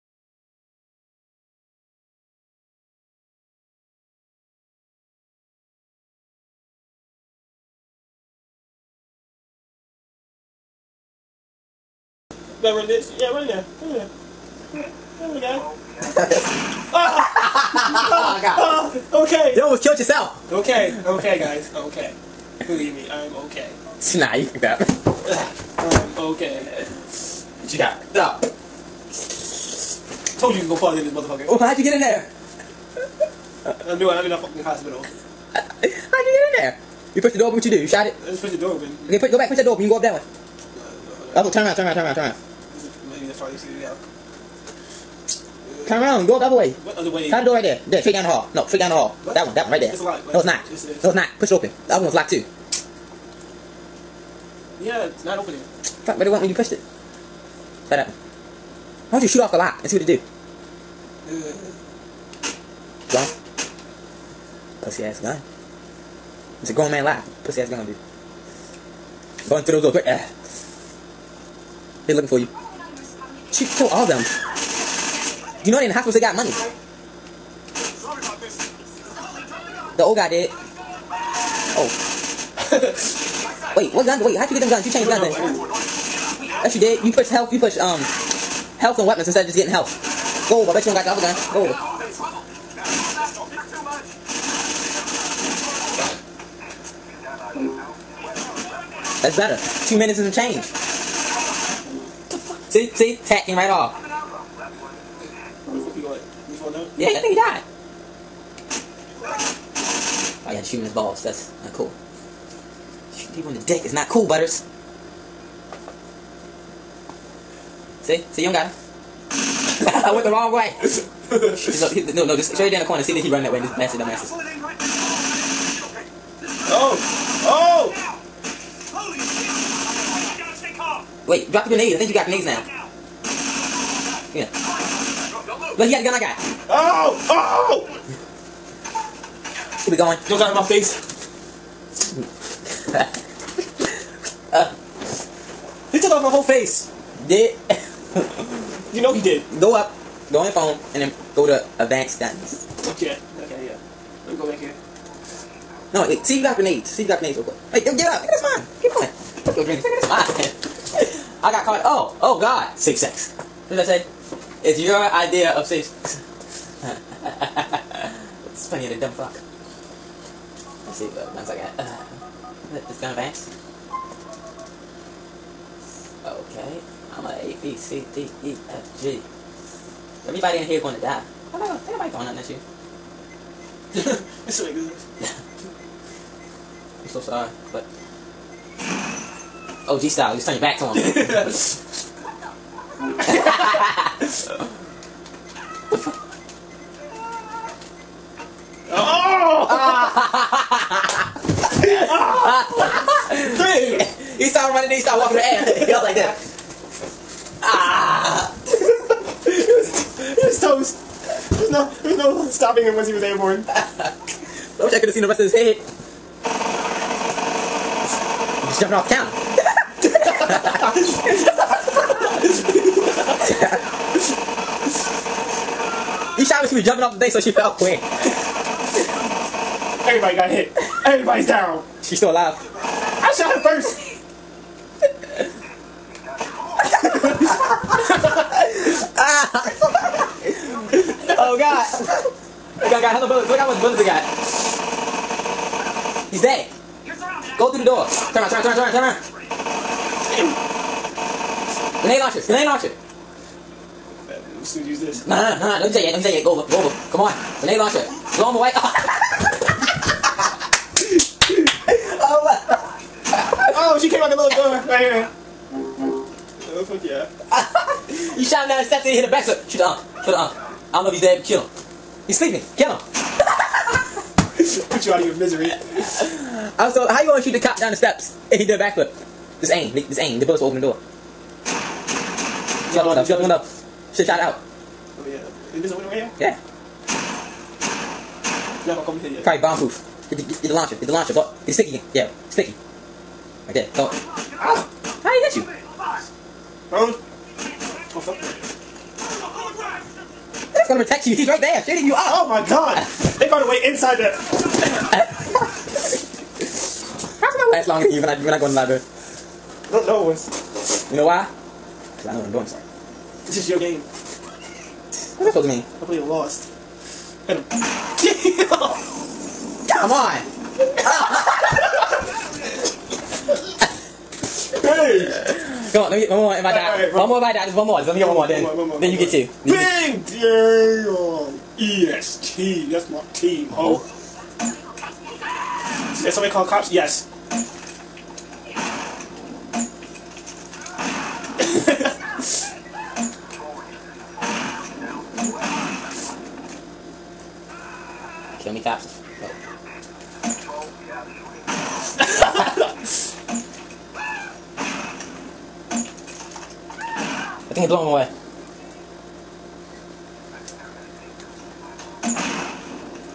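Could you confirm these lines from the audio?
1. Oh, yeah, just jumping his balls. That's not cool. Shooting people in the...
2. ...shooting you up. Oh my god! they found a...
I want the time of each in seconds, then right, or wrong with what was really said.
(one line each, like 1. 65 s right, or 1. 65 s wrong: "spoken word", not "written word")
1. 110 s wrong: "shooting", not "jumping"
2. 301 s right.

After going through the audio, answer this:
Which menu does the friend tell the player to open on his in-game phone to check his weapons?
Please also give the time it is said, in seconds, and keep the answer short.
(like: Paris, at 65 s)
advanced guns, at 151 s.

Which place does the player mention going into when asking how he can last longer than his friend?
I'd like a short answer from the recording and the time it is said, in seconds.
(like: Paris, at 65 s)
library, at 308 s.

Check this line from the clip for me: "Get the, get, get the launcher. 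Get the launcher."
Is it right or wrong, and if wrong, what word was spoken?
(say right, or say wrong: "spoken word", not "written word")
right.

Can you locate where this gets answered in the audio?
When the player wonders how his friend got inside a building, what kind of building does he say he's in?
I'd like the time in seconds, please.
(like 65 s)
34 s.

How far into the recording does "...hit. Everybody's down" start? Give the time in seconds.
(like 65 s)
230 s.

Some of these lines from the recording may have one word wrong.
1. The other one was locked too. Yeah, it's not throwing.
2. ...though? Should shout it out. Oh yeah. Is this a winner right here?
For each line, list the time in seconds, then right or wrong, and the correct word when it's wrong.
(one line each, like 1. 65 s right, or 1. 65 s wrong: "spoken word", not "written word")
1. 51 s wrong: "opening", not "throwing"
2. 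283 s right.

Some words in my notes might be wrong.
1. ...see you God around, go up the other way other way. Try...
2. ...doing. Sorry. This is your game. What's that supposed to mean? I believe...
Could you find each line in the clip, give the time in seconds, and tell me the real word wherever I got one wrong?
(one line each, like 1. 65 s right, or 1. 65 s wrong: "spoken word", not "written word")
1. 43 s wrong: "Turn", not "God"
2. 312 s right.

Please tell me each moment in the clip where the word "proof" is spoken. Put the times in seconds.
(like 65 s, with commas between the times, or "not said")
289 s.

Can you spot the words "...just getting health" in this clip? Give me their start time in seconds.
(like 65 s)
89 s.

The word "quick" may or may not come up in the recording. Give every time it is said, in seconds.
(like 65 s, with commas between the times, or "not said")
157 s, 227 s.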